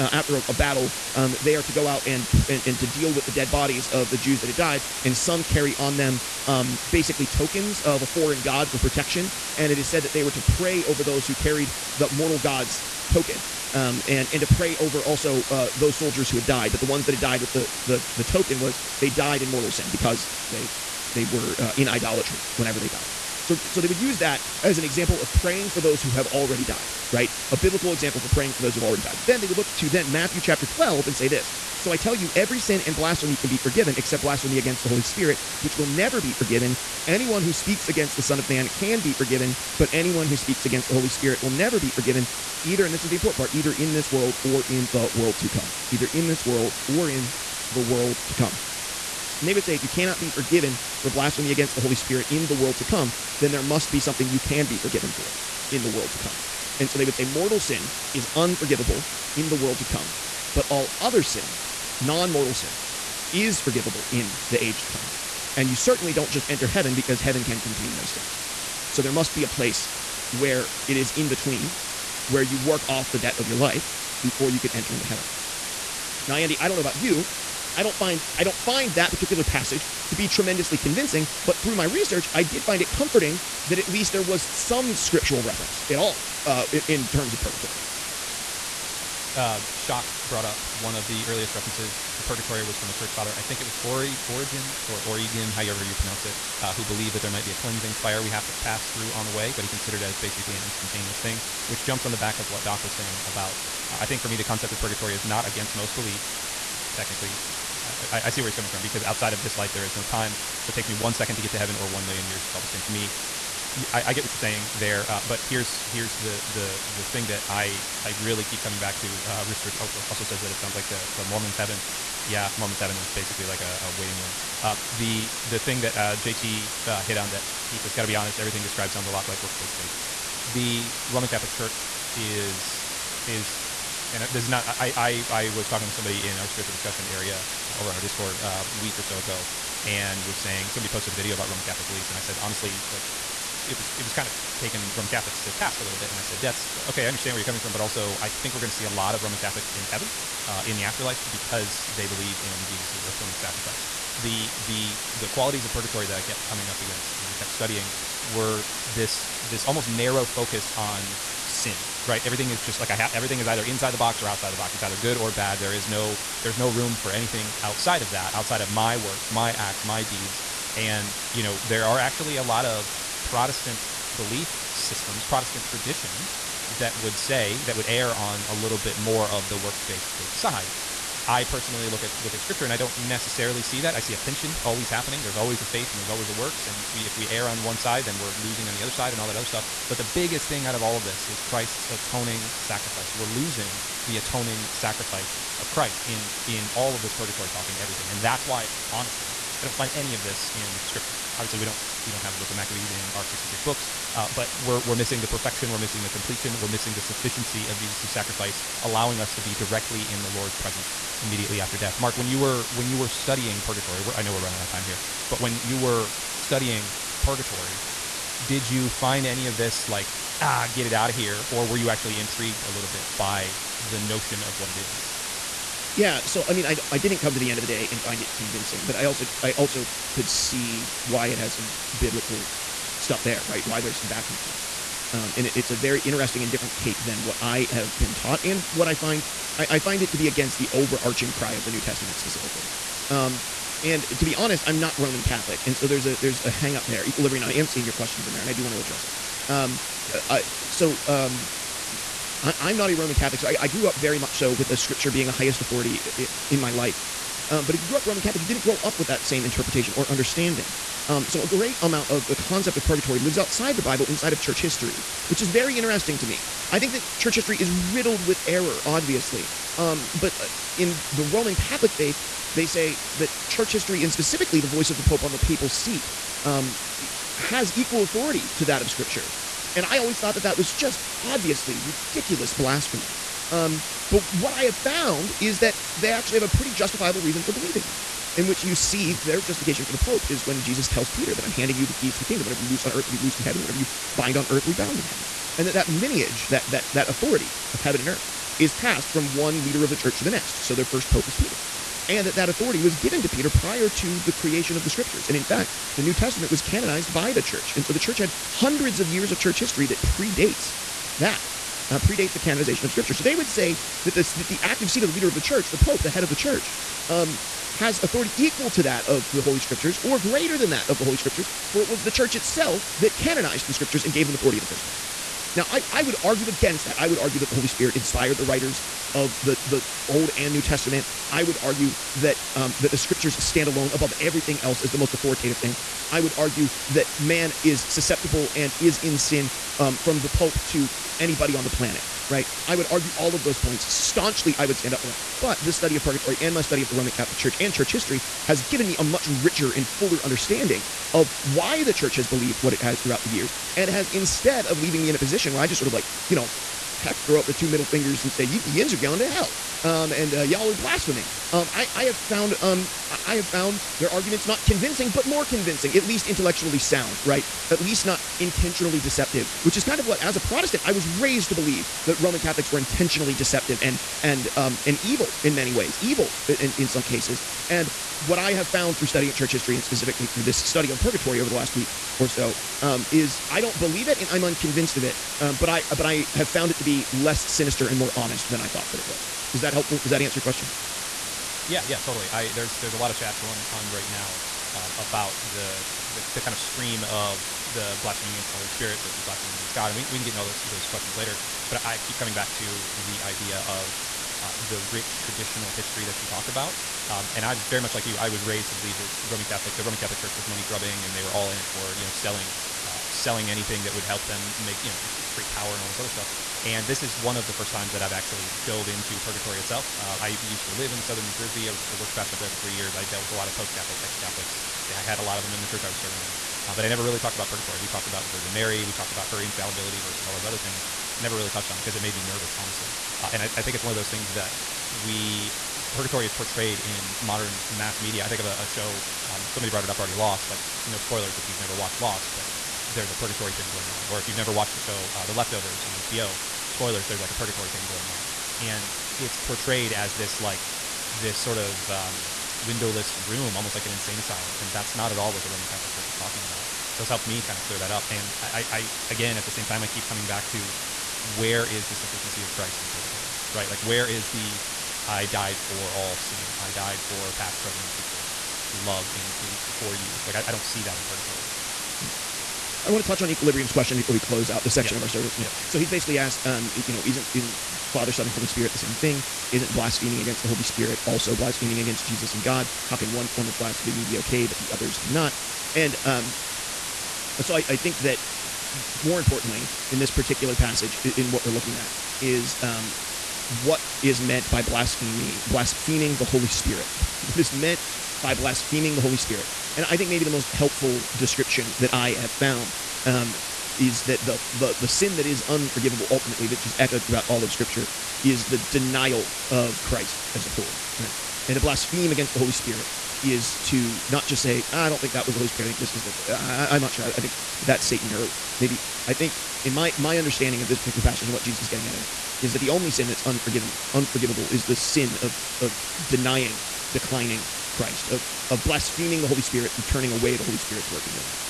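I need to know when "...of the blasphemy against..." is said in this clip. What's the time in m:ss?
6:37.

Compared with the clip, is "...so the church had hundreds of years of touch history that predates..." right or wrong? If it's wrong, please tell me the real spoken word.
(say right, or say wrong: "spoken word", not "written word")
wrong: "church", not "touch".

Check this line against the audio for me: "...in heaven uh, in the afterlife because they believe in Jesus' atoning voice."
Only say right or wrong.
wrong.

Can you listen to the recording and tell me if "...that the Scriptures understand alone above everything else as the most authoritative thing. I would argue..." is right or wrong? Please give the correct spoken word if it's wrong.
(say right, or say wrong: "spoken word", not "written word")
wrong: "stand", not "understand".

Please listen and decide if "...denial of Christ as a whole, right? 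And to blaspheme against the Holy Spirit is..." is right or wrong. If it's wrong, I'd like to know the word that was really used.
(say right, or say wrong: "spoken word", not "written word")
right.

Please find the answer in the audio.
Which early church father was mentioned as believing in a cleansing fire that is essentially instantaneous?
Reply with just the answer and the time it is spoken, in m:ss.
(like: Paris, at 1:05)
Origen, at 1:34.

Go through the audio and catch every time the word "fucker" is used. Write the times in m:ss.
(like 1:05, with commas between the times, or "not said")
not said.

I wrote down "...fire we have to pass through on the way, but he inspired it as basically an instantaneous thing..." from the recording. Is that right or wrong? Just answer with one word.
wrong.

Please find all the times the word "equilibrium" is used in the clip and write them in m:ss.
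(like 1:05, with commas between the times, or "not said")
4:07, 7:53.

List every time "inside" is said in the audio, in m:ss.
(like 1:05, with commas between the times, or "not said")
2:43, 4:24.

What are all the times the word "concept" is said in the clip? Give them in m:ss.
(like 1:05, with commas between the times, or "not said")
1:44, 4:22.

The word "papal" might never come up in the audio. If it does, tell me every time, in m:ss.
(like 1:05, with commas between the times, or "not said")
4:35.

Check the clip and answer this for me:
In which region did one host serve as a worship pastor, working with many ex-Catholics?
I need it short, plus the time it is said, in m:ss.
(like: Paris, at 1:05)
southern New Jersey, at 7:01.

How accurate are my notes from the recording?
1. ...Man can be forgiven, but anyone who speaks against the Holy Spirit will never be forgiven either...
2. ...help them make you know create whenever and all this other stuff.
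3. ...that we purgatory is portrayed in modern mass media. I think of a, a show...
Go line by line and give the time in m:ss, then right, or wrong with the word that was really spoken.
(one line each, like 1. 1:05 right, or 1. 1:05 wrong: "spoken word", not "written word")
1. 0:38 right
2. 6:54 wrong: "power", not "whenever"
3. 7:14 right.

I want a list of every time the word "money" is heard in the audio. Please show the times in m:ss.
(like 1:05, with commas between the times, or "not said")
6:50.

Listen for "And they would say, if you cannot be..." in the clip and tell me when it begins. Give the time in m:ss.
0:49.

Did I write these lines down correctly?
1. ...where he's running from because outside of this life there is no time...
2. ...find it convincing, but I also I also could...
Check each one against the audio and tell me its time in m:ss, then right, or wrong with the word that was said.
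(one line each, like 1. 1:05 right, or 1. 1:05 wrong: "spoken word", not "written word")
1. 1:48 wrong: "coming", not "running"
2. 3:47 right.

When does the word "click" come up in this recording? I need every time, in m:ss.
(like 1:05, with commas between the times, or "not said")
not said.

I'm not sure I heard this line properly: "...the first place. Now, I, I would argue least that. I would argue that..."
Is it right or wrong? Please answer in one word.
wrong.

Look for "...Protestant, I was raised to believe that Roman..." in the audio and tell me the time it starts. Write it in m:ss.
6:10.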